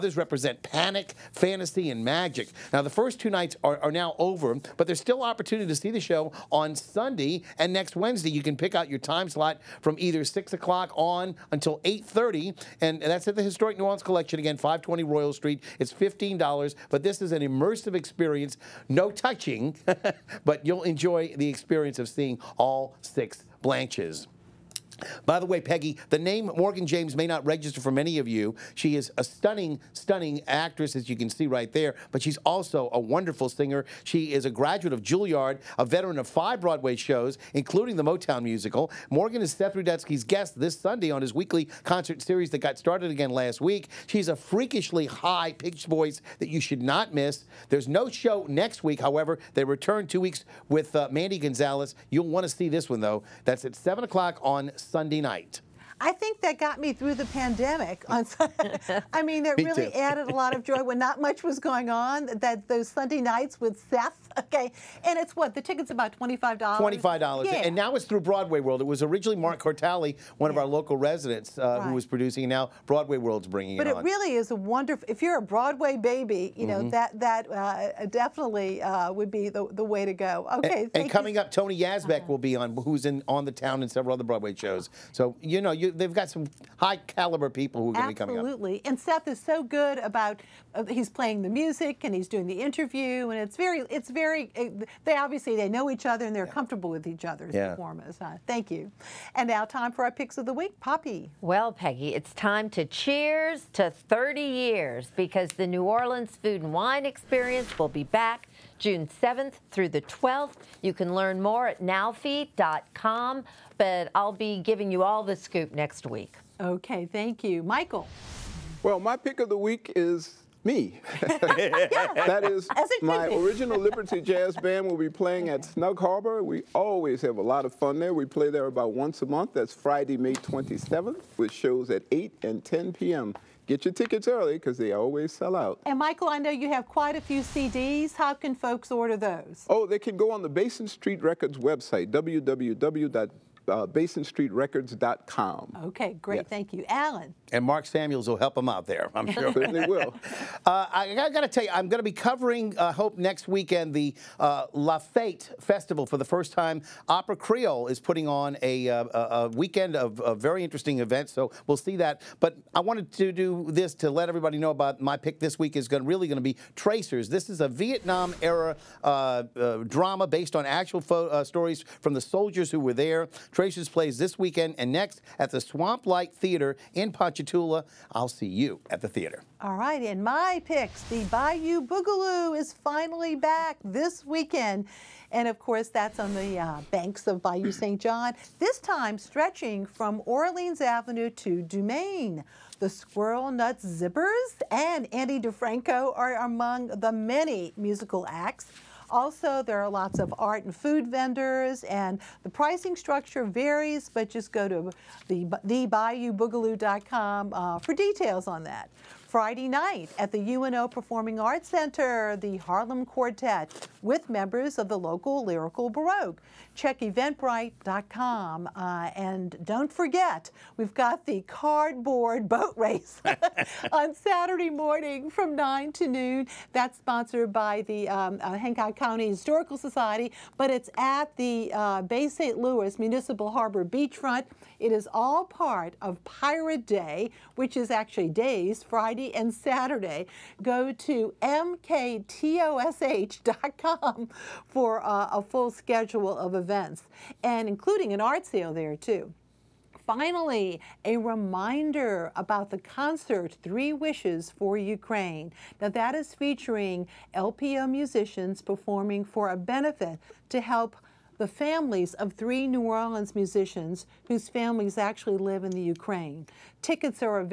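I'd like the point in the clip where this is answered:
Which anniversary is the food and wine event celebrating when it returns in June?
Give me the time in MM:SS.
01:43.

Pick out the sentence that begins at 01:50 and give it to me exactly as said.
You can learn more at nowfe.com but I'll be giving you all the scoop next week.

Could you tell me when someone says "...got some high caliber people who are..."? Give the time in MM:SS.
01:26.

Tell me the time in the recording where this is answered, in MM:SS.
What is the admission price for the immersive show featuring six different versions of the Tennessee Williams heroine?
00:15.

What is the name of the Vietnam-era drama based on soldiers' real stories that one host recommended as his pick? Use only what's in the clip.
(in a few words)
Tracers.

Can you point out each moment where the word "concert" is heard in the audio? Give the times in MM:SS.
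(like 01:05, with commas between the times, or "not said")
00:41, 04:12.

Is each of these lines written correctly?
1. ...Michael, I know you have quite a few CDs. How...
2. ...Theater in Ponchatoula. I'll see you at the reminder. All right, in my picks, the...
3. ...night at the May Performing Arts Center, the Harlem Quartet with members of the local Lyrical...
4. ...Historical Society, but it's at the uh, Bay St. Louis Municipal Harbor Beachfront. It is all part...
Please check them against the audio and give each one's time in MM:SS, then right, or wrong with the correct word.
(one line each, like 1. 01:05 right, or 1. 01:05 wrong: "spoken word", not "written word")
1. 02:15 right
2. 02:56 wrong: "theater", not "reminder"
3. 03:29 wrong: "UNO", not "May"
4. 03:49 right.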